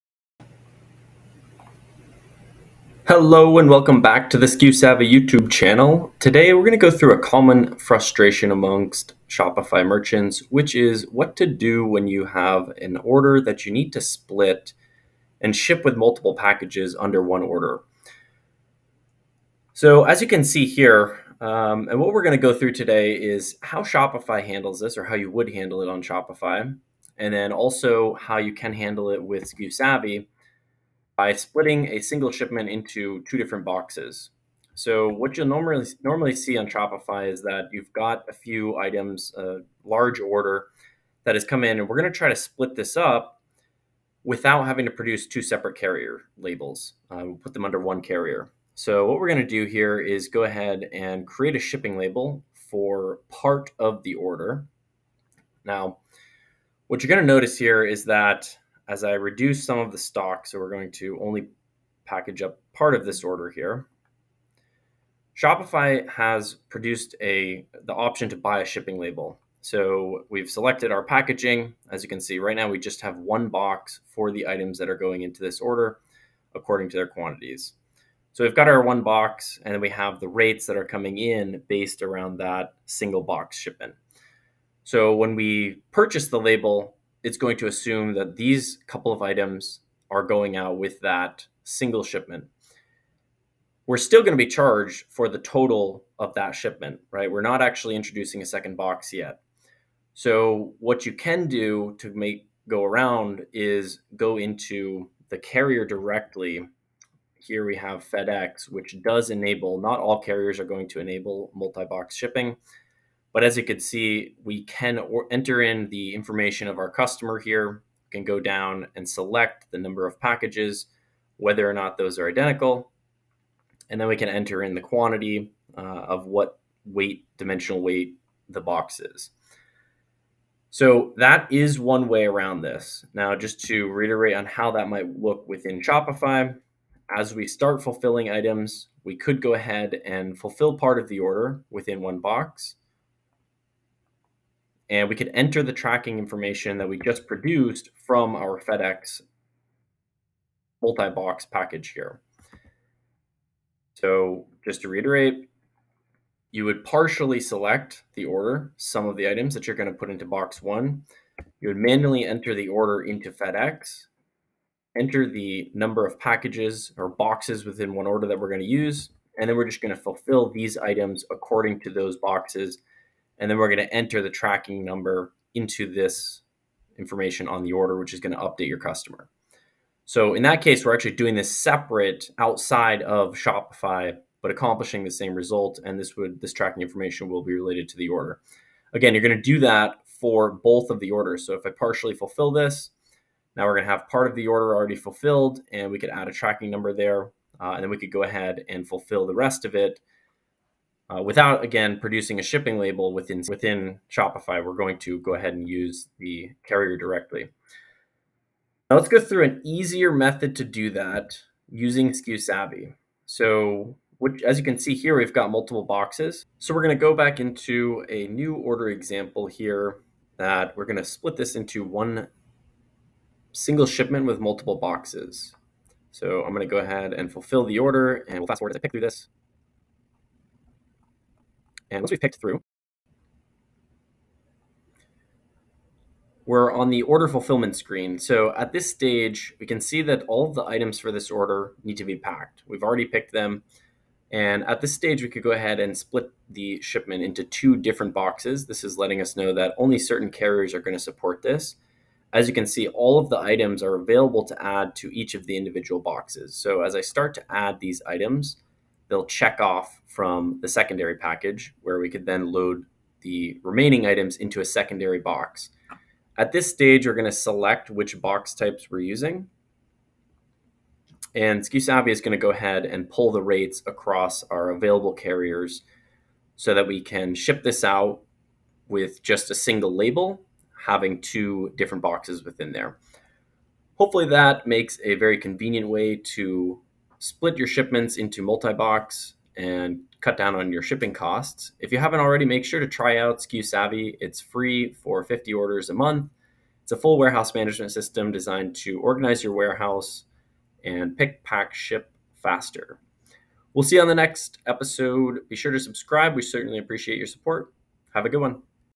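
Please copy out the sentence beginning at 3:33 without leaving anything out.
So which, as you can see here, we've got multiple boxes.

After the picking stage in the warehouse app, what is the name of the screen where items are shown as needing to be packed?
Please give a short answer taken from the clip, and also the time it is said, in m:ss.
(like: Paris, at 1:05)
order fulfillment screen, at 3:57.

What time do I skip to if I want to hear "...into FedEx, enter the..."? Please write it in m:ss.
2:43.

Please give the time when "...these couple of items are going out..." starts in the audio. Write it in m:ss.
1:28.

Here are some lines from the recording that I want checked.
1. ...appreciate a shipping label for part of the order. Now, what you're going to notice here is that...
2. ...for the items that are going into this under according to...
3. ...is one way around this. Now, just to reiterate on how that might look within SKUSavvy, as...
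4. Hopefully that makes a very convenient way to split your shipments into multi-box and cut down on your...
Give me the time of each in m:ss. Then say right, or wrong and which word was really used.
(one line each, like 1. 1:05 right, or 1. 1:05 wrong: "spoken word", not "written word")
1. 0:51 wrong: "create", not "appreciate"
2. 1:14 wrong: "order", not "under"
3. 2:11 wrong: "Shopify", not "SKUSavvy"
4. 4:43 right.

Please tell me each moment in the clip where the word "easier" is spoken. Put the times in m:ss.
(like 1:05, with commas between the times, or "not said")
3:29.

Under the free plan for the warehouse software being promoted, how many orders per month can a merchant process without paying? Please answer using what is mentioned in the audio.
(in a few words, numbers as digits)
50.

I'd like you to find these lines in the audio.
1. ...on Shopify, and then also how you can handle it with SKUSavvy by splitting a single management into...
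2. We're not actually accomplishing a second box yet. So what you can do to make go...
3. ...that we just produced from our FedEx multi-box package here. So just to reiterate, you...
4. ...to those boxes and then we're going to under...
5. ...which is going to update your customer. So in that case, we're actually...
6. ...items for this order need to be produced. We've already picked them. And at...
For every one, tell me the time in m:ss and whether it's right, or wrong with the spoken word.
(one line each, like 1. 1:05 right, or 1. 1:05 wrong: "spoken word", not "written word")
1. 0:25 wrong: "shipment", not "management"
2. 1:37 wrong: "introducing", not "accomplishing"
3. 2:26 right
4. 2:51 wrong: "enter", not "under"
5. 2:57 right
6. 4:00 wrong: "packed", not "produced".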